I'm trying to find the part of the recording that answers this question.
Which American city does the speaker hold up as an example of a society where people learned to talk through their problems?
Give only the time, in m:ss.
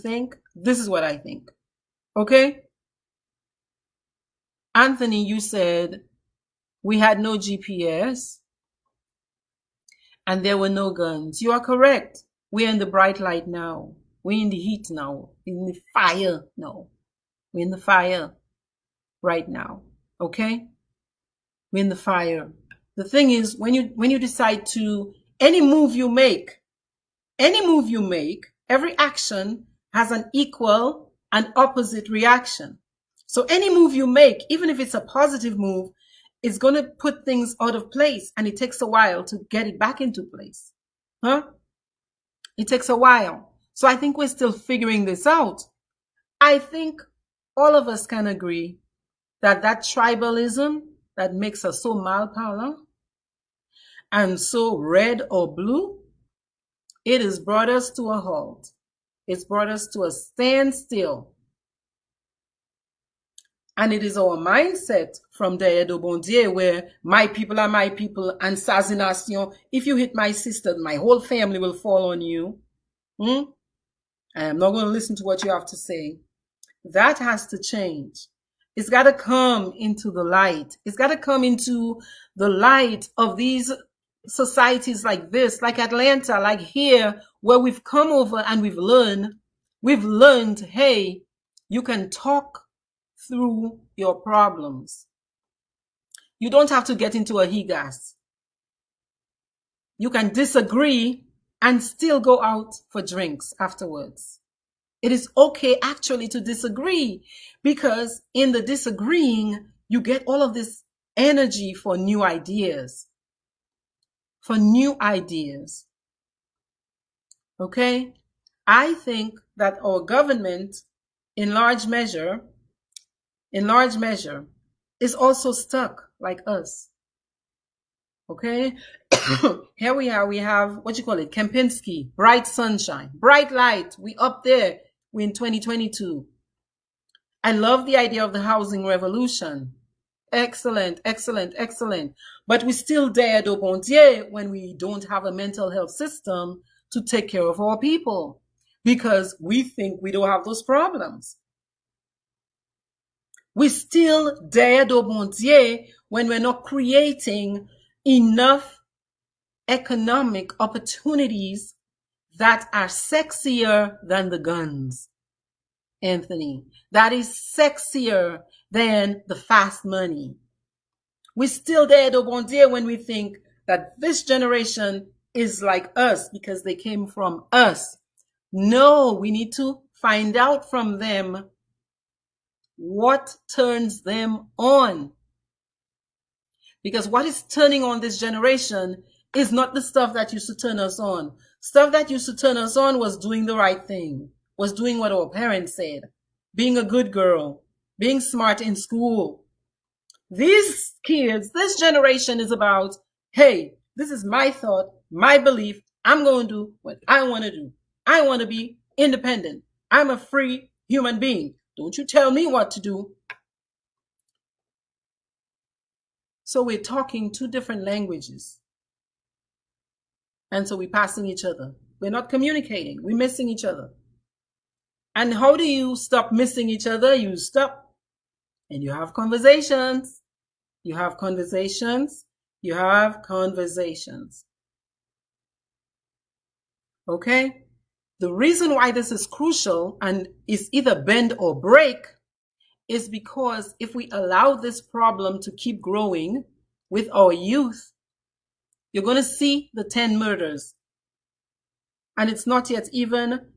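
1:25.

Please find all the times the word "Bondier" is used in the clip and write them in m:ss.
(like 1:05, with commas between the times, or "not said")
1:05, 2:35.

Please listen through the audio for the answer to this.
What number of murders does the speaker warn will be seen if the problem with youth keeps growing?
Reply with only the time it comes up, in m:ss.
4:09.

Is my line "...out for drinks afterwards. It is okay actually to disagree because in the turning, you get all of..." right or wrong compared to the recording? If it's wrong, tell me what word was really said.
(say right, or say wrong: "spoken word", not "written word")
wrong: "disagreeing", not "turning".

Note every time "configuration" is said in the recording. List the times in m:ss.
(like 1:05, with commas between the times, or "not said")
not said.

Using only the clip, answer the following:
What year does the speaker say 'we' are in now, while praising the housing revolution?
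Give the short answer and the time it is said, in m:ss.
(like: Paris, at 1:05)
2022, at 2:15.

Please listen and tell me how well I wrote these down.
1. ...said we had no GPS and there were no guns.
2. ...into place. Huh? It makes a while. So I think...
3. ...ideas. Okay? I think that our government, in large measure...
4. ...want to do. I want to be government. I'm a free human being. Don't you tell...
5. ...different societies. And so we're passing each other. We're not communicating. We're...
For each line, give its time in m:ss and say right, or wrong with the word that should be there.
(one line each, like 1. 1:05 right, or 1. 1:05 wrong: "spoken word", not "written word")
1. 0:05 right
2. 0:40 wrong: "takes", not "makes"
3. 1:54 right
4. 3:27 wrong: "independent", not "government"
5. 3:37 wrong: "languages", not "societies".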